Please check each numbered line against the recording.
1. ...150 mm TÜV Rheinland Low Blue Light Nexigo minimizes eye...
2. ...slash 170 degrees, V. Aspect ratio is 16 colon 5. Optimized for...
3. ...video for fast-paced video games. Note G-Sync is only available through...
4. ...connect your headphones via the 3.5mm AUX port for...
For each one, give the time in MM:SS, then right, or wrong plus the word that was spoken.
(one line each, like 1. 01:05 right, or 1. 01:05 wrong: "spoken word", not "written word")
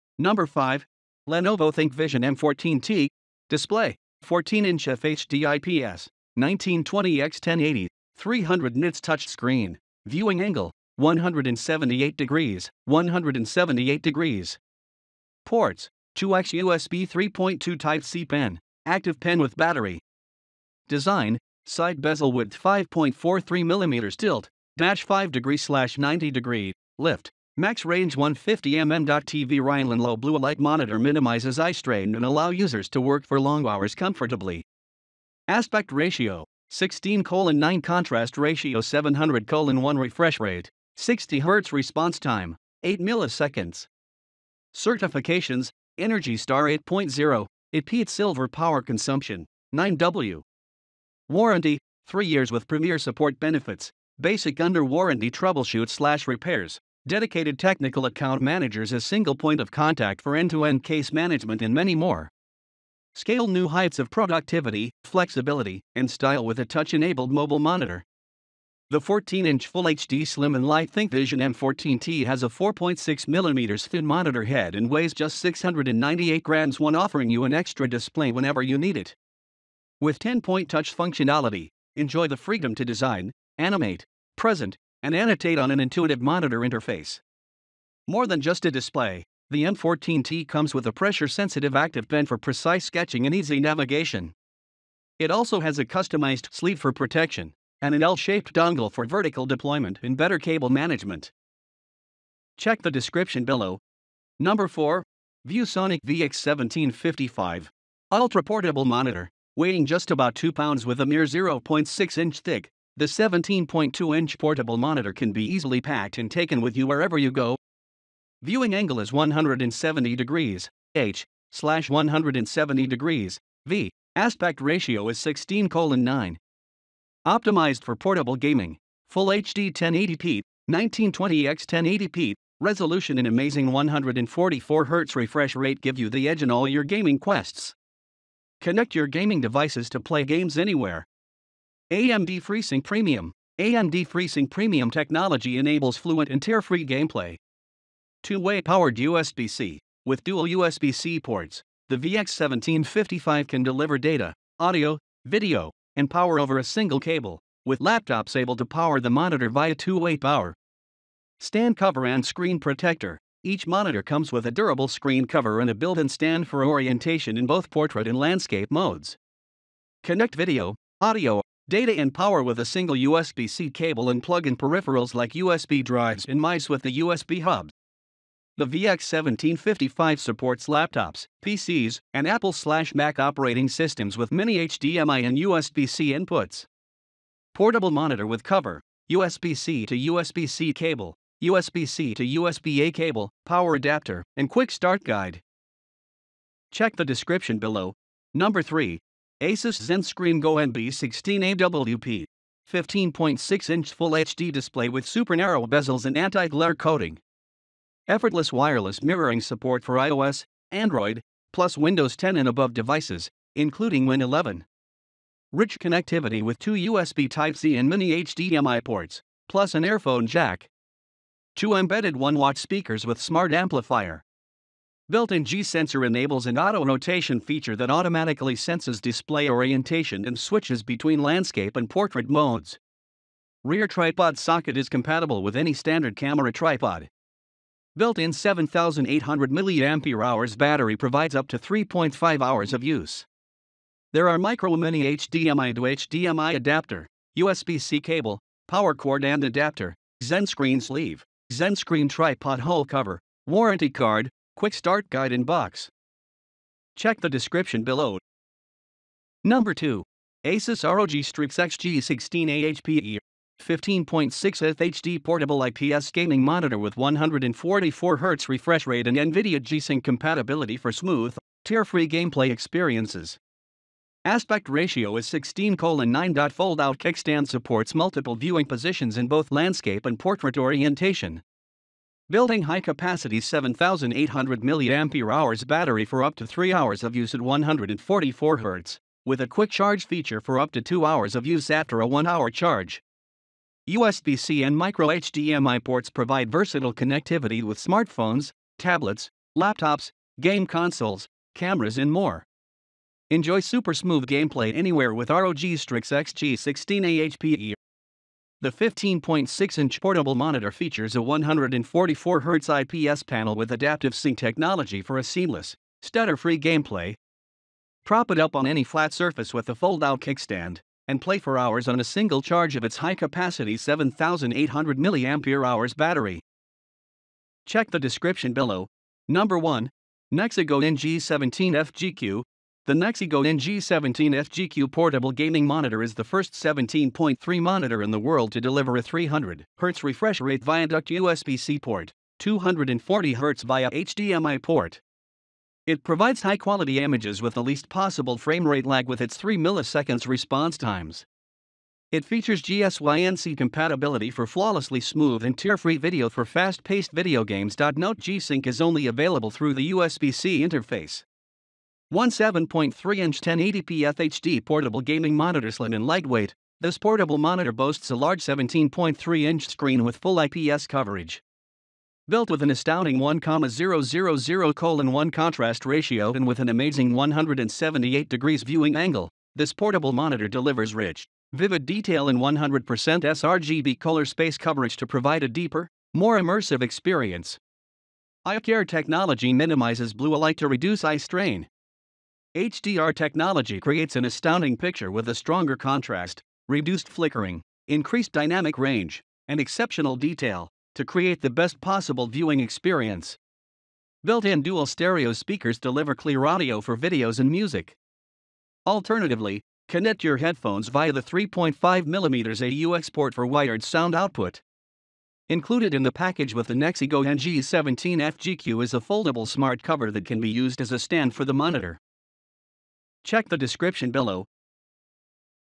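1. 00:28 wrong: "Monitor", not "Nexigo"
2. 02:01 wrong: "9", not "5"
3. 05:55 right
4. 06:49 right.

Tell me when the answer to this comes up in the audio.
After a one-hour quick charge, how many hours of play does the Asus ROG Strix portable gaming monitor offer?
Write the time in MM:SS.
04:50.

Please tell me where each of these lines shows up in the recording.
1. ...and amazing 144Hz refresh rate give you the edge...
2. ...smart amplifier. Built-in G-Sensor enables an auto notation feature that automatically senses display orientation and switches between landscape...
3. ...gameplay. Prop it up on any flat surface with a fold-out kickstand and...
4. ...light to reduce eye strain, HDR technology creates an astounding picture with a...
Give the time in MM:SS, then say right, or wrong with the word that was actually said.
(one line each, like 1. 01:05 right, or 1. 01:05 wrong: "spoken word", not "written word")
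1. 02:13 right
2. 03:43 right
3. 05:16 right
4. 06:30 right.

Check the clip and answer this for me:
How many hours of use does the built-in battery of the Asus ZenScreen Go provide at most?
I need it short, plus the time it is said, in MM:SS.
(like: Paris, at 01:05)
3.5 hours, at 04:01.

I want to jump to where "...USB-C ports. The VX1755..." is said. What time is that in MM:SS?
02:30.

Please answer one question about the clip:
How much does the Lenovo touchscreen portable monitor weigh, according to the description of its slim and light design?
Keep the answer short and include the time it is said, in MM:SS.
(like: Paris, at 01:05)
698 grams, at 01:15.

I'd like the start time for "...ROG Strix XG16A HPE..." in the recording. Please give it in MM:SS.
04:20.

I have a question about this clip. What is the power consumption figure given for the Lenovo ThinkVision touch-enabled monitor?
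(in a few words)
9W.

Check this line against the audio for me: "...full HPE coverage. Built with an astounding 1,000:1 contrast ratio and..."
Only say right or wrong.
wrong.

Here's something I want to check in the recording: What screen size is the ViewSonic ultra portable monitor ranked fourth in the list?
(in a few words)
17.2-inch.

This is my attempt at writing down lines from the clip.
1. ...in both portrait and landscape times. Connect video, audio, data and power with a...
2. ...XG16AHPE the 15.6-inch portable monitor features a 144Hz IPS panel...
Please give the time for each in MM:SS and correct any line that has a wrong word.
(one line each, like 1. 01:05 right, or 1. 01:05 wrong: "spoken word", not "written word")
1. 02:47 wrong: "modes", not "times"
2. 05:06 right.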